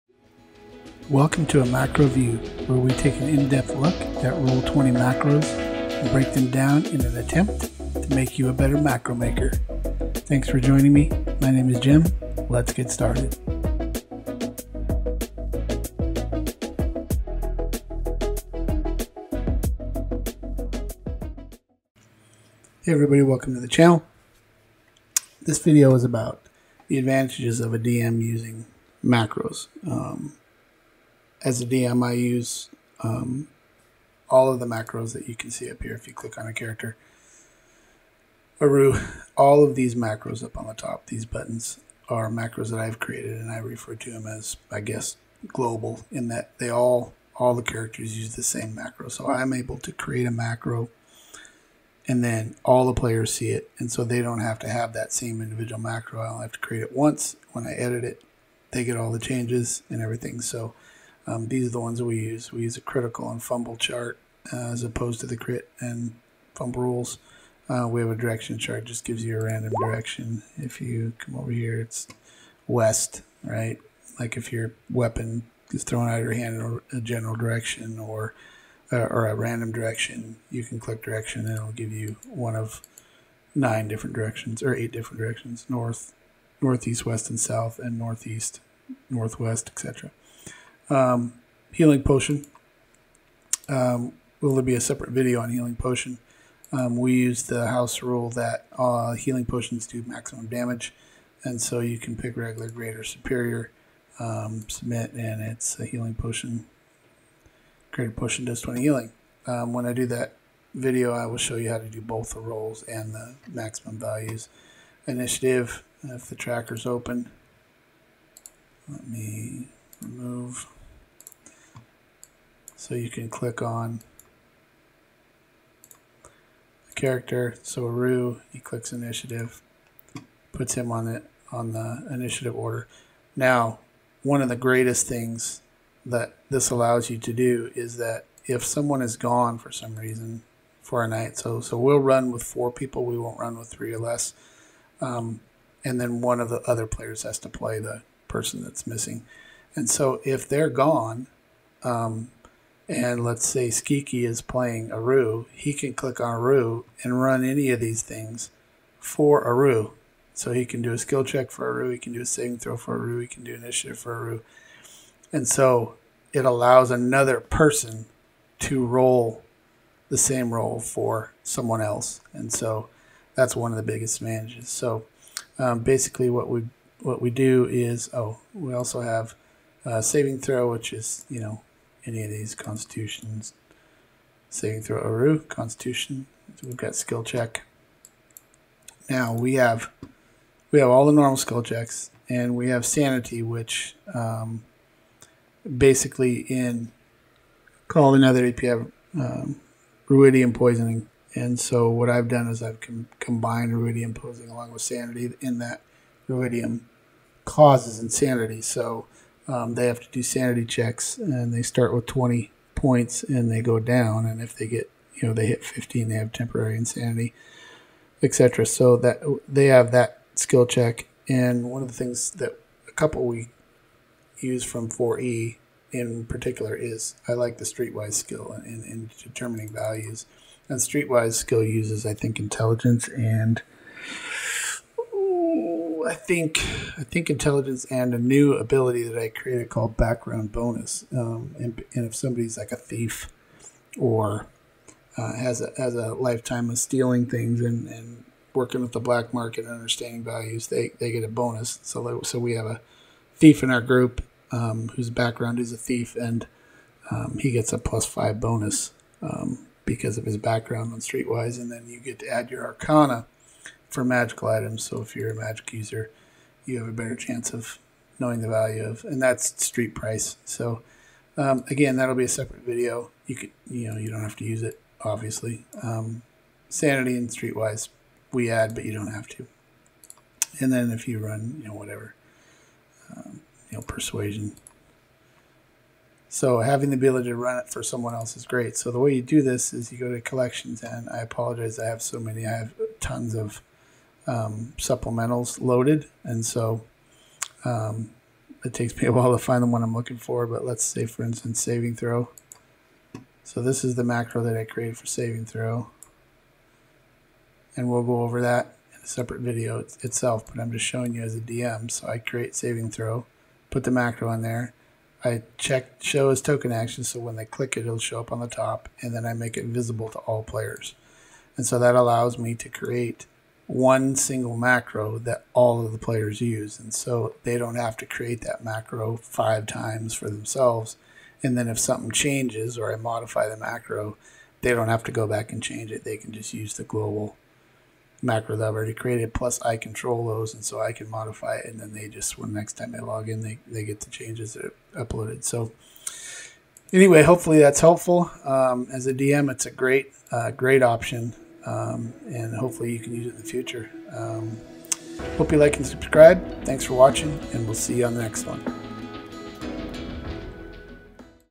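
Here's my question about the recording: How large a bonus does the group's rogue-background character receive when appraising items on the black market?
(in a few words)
+5.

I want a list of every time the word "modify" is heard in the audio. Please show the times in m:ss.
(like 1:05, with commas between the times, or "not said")
5:32, 5:41.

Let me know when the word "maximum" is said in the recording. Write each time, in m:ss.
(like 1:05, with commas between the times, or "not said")
1:40, 1:53.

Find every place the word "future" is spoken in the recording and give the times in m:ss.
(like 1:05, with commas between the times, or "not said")
5:53.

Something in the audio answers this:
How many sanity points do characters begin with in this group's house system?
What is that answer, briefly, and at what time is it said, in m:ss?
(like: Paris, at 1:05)
20, at 3:32.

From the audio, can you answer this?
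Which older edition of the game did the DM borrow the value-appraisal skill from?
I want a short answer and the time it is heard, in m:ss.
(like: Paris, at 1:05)
4e, at 3:44.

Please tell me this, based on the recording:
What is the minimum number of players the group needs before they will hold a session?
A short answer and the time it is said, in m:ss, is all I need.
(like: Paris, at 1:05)
4, at 2:22.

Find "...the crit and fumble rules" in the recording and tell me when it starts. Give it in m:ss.
1:05.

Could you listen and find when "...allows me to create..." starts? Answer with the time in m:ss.
5:21.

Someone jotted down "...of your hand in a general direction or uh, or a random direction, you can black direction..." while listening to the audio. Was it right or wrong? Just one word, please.
wrong.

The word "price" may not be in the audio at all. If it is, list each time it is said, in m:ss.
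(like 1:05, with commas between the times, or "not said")
4:29.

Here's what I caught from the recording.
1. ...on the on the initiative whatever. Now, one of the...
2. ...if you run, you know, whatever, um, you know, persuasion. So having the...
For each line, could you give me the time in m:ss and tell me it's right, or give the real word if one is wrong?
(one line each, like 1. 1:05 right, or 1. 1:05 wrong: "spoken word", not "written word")
1. 2:10 wrong: "order", not "whatever"
2. 4:40 right.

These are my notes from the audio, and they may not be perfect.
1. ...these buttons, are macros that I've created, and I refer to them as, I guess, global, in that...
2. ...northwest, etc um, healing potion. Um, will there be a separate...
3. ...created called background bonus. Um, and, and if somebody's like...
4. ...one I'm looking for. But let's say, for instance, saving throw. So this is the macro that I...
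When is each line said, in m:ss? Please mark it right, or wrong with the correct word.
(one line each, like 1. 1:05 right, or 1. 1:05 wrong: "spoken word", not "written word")
1. 0:41 right
2. 1:29 right
3. 3:59 right
4. 4:59 right.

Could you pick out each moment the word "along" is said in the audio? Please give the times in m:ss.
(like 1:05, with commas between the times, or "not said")
3:24.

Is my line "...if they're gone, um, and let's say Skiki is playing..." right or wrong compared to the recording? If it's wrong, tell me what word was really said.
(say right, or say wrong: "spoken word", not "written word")
right.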